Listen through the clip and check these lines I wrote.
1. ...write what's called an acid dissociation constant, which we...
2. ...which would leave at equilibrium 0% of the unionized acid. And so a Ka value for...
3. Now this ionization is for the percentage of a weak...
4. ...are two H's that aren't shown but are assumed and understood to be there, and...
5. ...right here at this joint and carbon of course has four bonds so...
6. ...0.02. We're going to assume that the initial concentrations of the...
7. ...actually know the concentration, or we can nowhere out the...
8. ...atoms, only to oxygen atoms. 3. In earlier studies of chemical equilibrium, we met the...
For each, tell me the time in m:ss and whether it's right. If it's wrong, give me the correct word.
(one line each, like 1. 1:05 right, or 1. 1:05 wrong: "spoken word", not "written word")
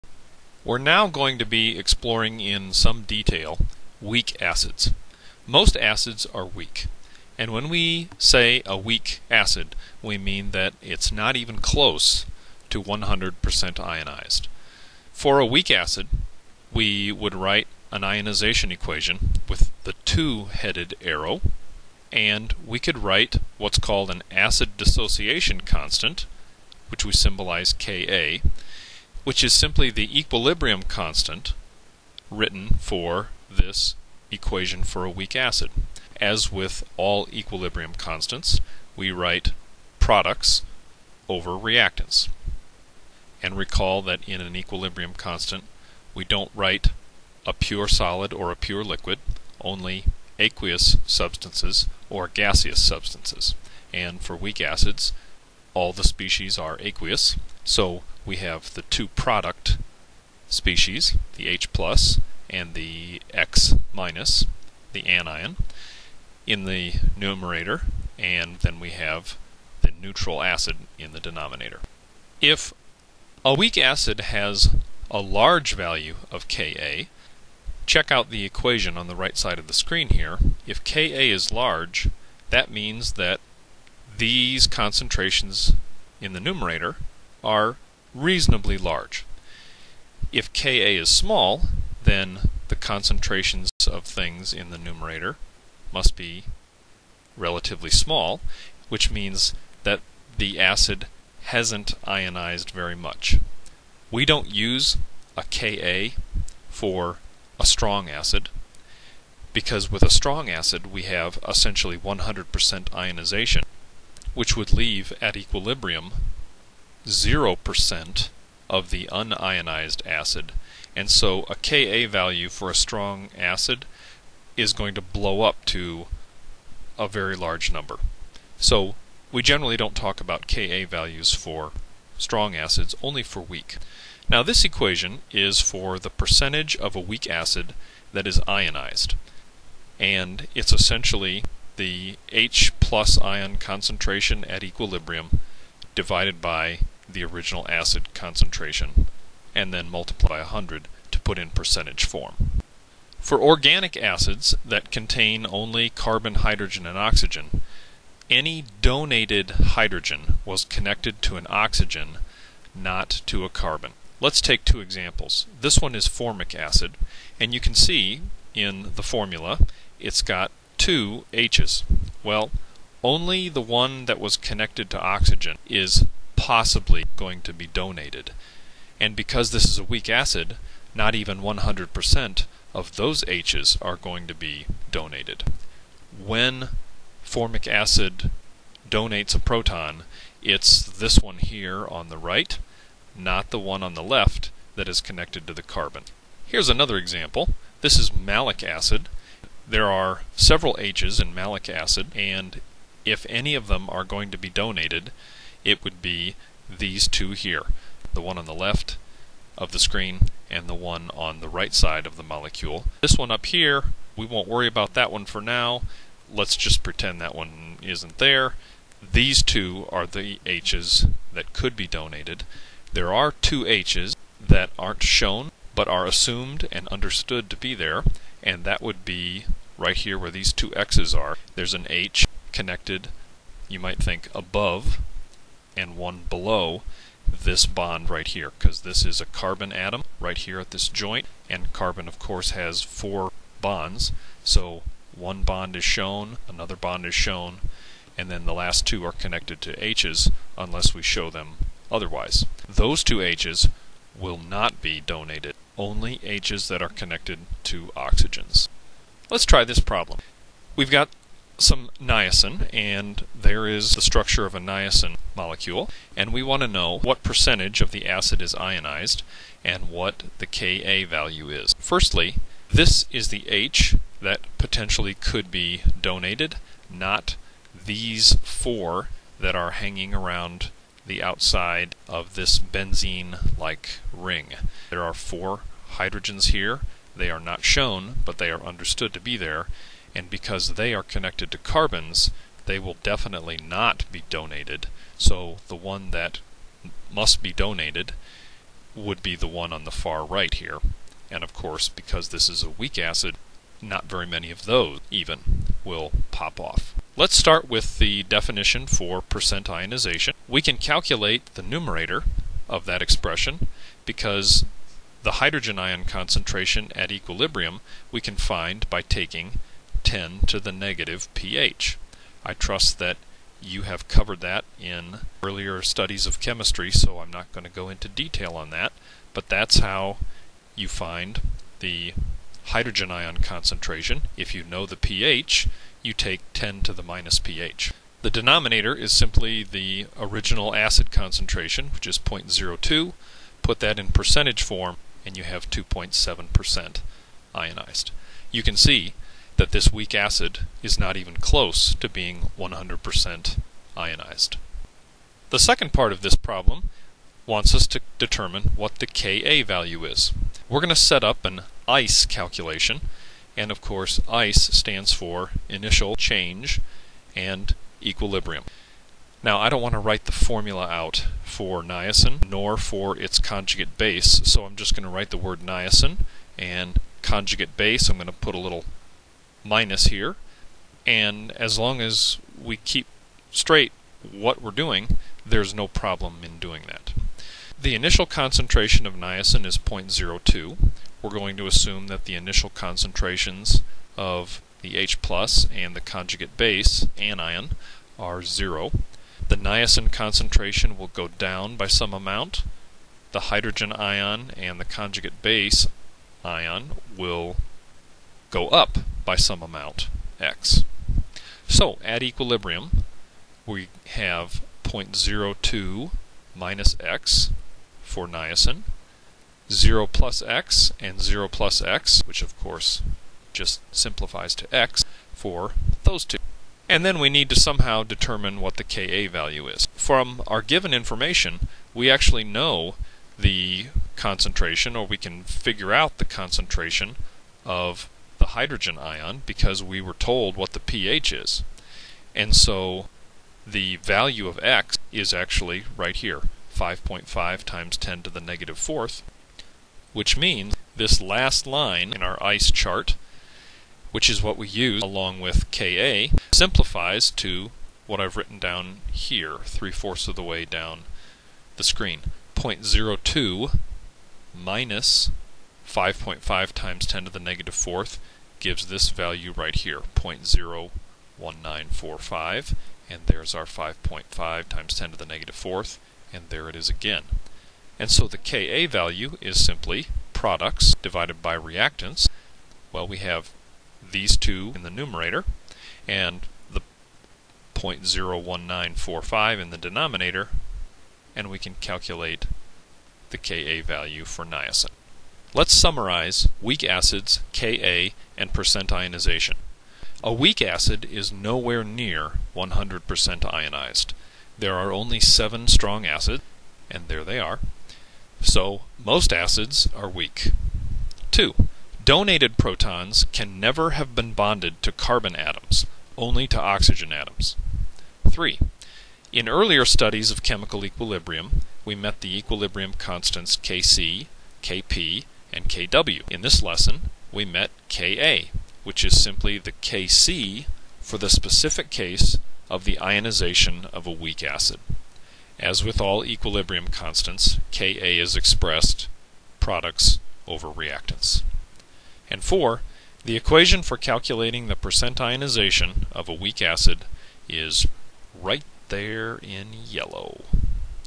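1. 0:22 right
2. 1:54 right
3. 2:14 wrong: "equation", not "ionization"
4. 3:43 right
5. 4:00 right
6. 6:29 right
7. 7:12 wrong: "figure", not "nowhere"
8. 8:35 right.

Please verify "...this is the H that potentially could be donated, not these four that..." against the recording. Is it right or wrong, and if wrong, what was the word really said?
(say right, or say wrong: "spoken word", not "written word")
right.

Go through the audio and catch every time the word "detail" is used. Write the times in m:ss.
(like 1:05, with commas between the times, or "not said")
0:03, 5:28.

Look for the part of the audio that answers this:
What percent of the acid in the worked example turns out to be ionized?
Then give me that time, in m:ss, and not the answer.
5:45.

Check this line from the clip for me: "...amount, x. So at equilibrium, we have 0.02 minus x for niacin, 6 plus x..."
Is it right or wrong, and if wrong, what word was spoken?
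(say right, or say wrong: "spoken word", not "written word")
wrong: "0", not "6".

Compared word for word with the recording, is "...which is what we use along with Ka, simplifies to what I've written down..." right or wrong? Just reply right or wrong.
right.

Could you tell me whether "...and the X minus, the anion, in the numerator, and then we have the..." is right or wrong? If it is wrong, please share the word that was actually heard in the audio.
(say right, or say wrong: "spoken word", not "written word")
right.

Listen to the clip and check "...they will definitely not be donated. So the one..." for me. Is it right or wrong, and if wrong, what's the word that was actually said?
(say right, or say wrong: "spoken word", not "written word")
right.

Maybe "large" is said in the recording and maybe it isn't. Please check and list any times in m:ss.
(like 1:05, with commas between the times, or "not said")
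1:15, 1:21, 1:28, 2:07.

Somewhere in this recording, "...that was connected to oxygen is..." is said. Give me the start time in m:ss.
2:54.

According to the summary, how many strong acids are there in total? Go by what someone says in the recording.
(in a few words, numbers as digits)
7.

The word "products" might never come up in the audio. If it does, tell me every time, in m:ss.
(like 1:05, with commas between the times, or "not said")
0:39, 0:59, 8:00, 8:59.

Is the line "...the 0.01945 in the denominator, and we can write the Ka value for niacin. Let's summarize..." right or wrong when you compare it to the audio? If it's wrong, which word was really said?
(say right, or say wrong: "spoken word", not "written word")
wrong: "calculate", not "write".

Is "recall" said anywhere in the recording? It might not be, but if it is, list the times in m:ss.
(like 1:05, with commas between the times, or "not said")
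0:43.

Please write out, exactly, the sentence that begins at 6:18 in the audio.
I'm going to put a little minus here.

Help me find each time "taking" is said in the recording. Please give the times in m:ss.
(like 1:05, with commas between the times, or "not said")
5:19.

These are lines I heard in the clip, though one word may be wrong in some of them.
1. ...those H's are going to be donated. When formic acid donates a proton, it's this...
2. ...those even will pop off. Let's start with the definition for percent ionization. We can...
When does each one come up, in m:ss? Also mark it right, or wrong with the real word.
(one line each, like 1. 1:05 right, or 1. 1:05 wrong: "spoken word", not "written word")
1. 3:02 right
2. 5:04 right.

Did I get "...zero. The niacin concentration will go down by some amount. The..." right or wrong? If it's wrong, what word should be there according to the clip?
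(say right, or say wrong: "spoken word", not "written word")
right.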